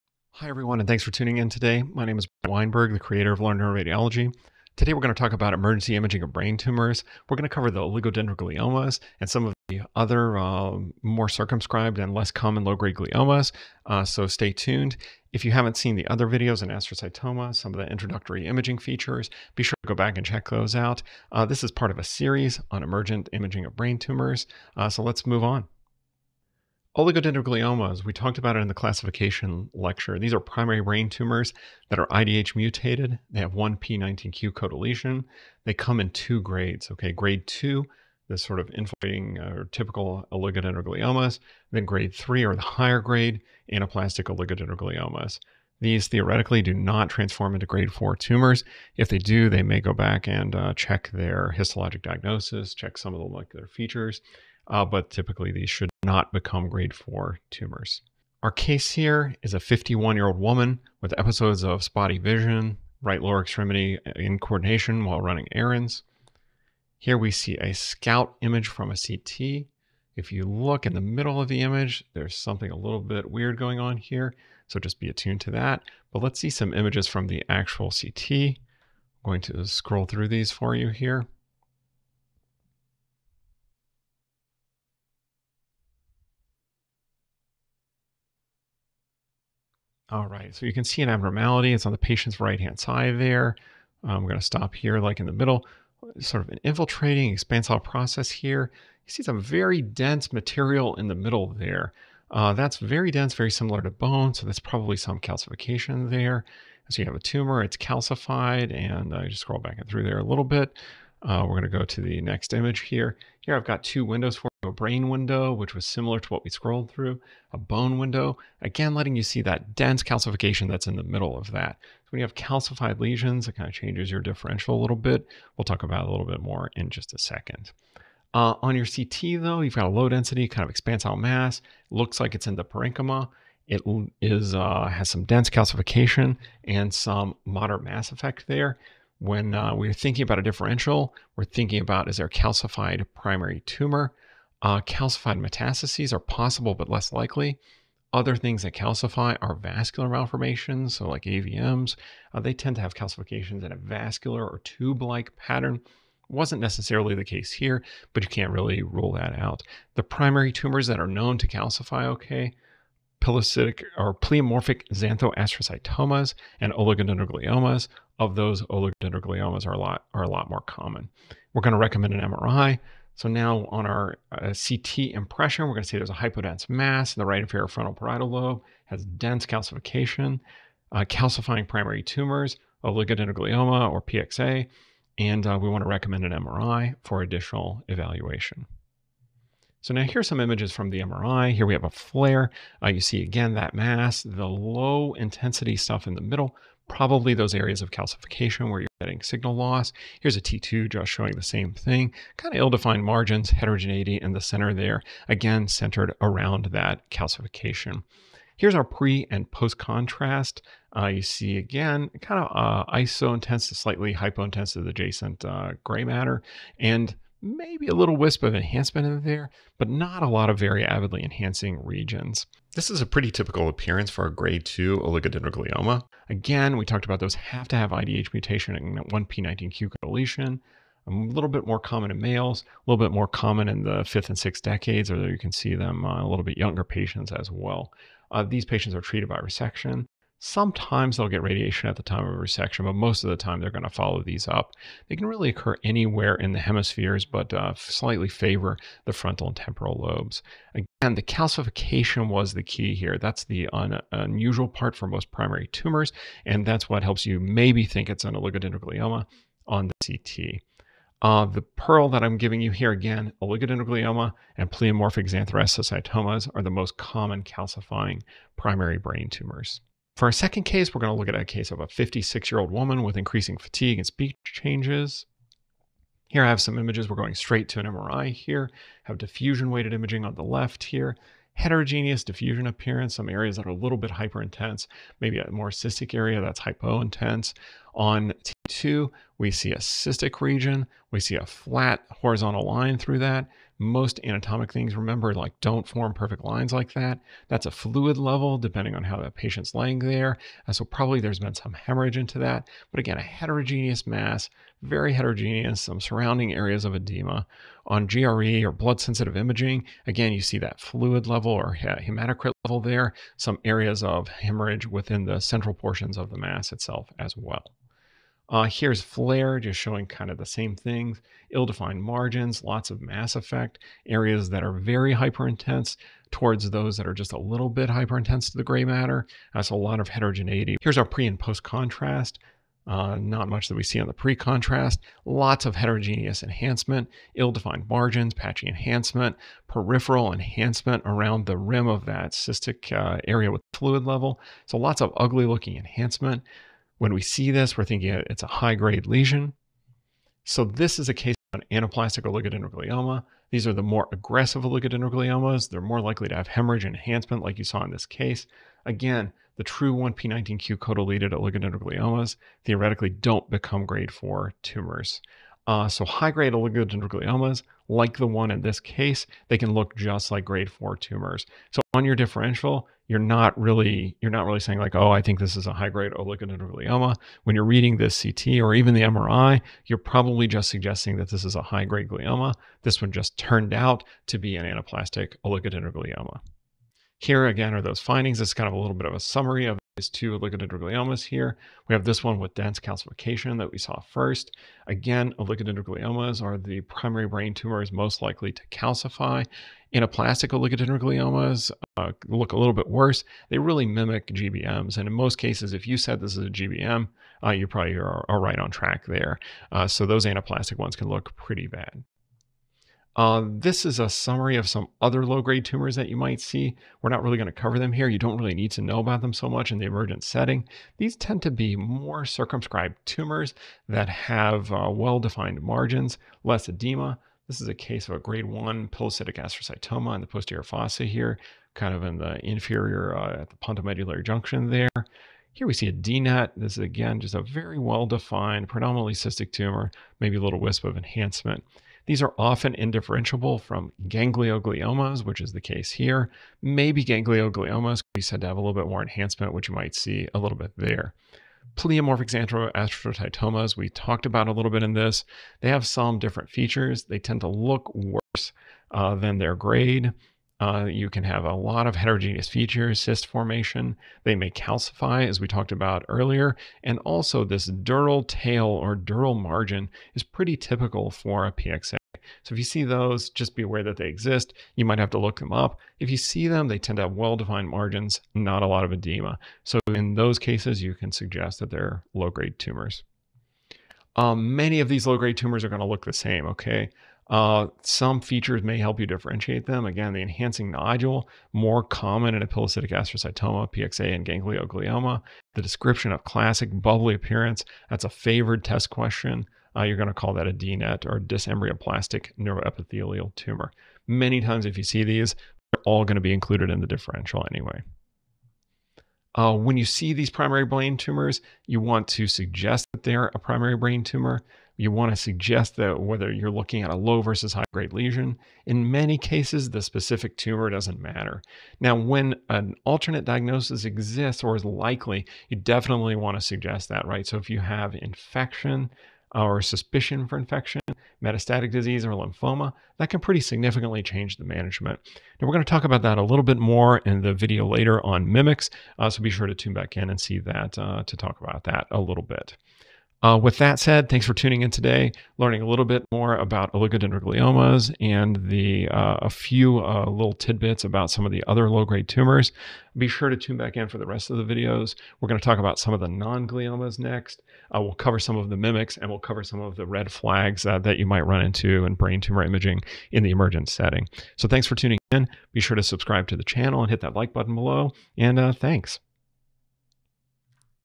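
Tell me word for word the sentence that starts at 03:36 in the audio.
And maybe a little wisp of enhancement in there, but not a lot of very avidly enhancing regions.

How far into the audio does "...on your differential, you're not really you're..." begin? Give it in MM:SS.
06:11.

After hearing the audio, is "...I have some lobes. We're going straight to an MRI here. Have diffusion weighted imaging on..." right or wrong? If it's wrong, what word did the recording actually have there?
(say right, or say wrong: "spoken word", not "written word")
wrong: "images", not "lobes".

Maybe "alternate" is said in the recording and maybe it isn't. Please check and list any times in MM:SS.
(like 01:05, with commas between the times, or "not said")
08:42.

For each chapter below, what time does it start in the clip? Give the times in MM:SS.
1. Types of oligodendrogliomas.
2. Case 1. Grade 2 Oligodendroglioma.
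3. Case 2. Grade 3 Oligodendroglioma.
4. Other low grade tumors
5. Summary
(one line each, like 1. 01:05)
1. 00:26
2. 00:58
3. 04:30
4. 06:52
5. 08:52.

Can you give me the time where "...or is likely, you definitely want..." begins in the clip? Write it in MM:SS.
08:44.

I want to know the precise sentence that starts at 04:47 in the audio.
On T2, we see a cystic region.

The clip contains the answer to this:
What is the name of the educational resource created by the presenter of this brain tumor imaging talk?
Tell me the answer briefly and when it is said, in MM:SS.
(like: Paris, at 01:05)
Learn Neuroradiology, at 00:03.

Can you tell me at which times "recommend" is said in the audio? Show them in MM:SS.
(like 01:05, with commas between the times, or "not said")
02:51, 03:05.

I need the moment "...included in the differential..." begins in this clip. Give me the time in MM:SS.
08:26.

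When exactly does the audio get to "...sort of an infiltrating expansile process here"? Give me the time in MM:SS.
01:36.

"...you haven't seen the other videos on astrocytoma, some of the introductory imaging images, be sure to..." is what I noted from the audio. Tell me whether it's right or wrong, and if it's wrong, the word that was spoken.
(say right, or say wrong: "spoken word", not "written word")
wrong: "features", not "images".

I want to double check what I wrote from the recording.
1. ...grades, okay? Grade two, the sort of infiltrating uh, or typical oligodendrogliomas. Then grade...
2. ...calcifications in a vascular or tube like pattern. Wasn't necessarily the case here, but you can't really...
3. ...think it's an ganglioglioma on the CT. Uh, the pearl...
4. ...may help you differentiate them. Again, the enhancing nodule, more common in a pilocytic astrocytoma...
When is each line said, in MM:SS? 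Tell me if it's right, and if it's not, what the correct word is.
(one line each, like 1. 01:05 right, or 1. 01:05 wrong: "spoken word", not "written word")
1. 00:36 right
2. 02:32 right
3. 04:17 wrong: "oligodendroglioma", not "ganglioglioma"
4. 08:08 right.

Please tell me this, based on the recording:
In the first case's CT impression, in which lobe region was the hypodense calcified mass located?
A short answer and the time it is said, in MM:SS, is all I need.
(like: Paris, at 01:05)
Right inferior frontal parietal lobe, at 02:57.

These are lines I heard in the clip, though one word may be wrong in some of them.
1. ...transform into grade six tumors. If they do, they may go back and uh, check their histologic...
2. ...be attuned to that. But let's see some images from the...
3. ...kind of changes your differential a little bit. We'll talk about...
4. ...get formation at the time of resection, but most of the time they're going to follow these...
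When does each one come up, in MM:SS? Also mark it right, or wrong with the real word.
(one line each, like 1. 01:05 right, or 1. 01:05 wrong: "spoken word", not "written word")
1. 00:47 wrong: "four", not "six"
2. 01:14 right
3. 02:03 right
4. 04:01 wrong: "radiation", not "formation".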